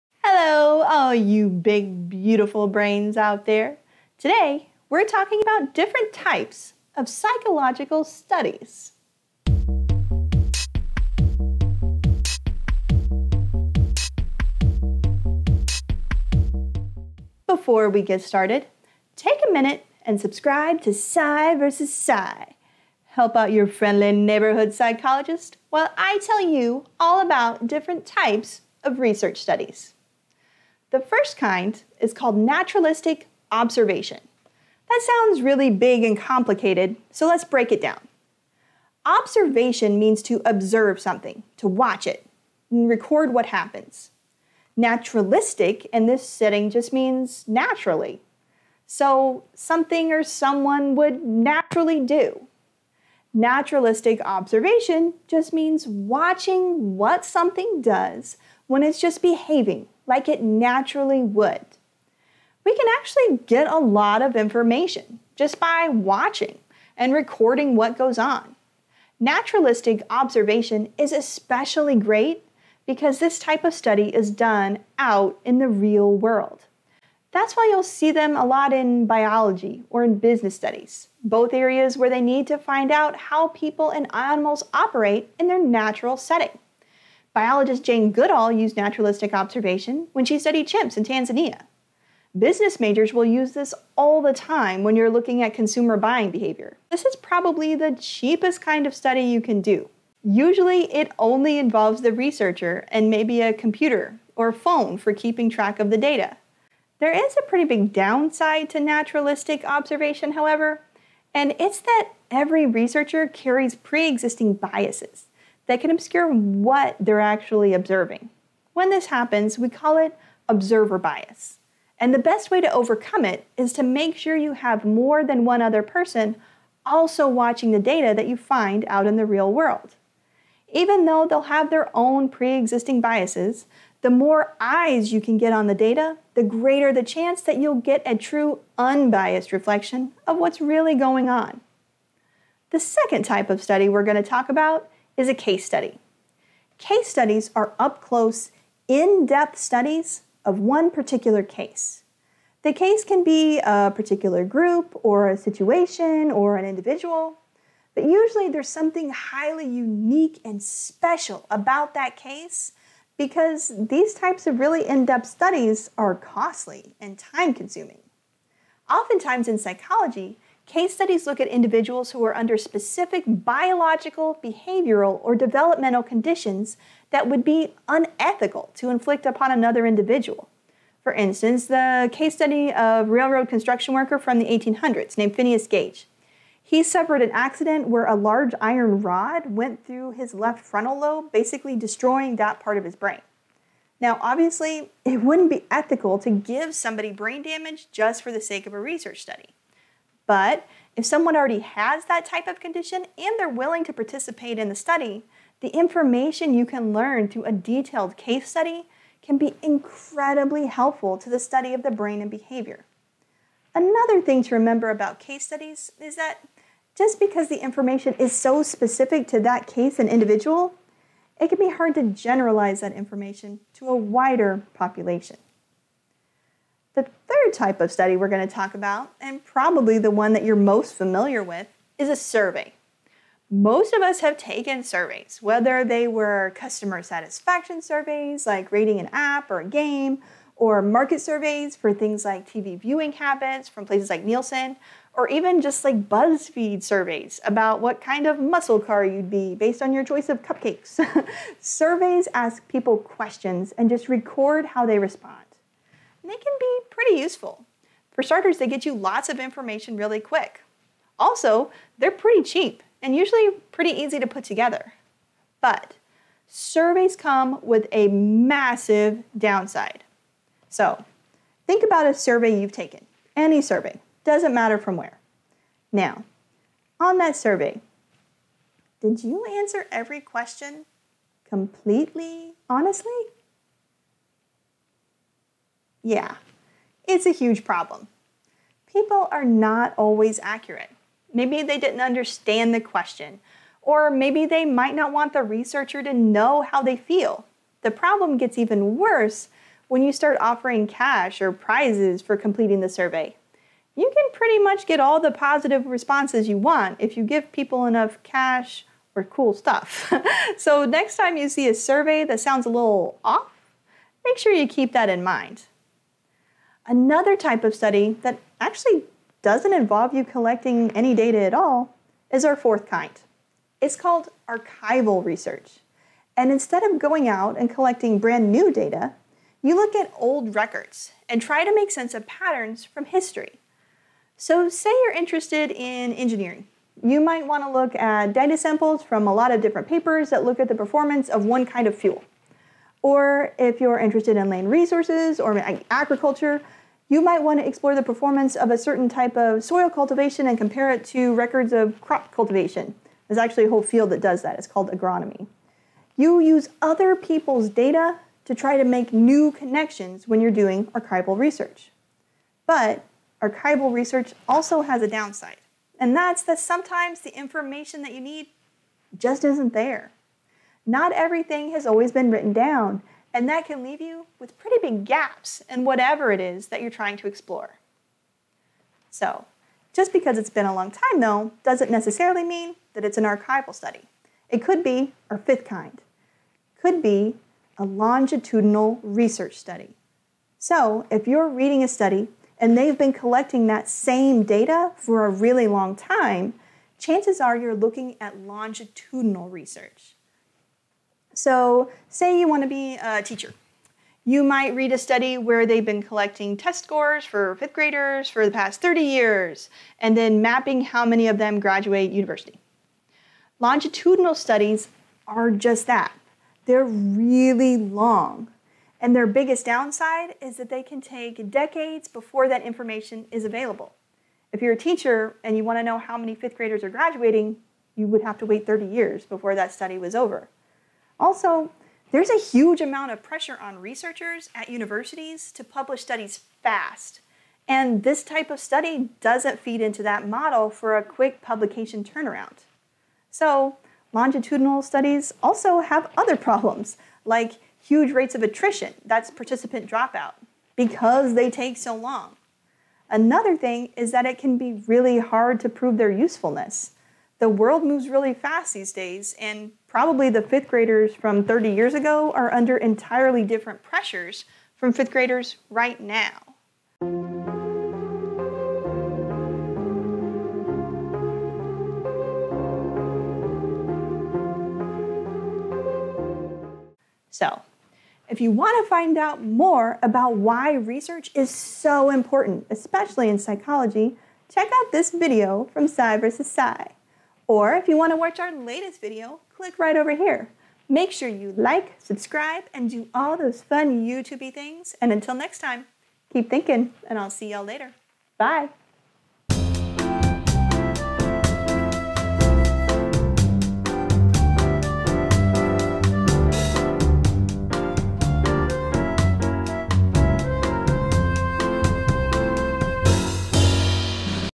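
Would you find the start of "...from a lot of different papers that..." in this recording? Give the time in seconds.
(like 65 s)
339 s.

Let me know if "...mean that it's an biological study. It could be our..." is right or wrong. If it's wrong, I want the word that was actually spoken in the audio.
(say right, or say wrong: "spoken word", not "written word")
wrong: "archival", not "biological".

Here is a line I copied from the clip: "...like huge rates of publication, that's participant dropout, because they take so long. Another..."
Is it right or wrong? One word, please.
wrong.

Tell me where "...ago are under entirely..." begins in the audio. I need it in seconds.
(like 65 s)
461 s.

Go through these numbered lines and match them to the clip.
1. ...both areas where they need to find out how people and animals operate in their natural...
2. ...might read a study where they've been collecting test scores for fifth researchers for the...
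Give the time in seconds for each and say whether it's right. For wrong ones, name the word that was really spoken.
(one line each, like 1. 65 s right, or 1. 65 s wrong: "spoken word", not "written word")
1. 81 s right
2. 404 s wrong: "graders", not "researchers".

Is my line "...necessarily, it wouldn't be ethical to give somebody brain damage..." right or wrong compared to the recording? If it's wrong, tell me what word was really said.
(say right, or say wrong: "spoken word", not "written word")
wrong: "obviously", not "necessarily".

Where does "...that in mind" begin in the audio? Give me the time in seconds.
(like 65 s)
314 s.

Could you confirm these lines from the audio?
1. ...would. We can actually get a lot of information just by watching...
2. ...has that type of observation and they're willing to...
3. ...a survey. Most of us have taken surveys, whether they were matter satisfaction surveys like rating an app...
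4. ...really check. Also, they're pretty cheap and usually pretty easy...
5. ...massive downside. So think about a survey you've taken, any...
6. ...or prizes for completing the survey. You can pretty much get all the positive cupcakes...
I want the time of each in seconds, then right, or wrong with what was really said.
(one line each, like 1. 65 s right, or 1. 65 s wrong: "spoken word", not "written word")
1. 61 s right
2. 201 s wrong: "condition", not "observation"
3. 232 s wrong: "customer", not "matter"
4. 259 s wrong: "quick", not "check"
5. 268 s right
6. 301 s wrong: "responses", not "cupcakes".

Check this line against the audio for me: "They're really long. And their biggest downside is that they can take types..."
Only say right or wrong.
wrong.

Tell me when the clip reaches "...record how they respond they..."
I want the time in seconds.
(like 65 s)
254 s.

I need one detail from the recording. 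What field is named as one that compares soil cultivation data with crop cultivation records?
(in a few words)
Agronomy.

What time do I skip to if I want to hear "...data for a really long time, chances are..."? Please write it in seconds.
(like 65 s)
394 s.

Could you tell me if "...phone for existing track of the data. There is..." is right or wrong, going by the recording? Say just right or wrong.
wrong.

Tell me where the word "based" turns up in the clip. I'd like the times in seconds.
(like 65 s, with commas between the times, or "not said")
249 s.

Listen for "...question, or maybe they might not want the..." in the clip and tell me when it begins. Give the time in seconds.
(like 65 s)
292 s.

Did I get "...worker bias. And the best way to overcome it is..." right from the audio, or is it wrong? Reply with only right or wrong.
wrong.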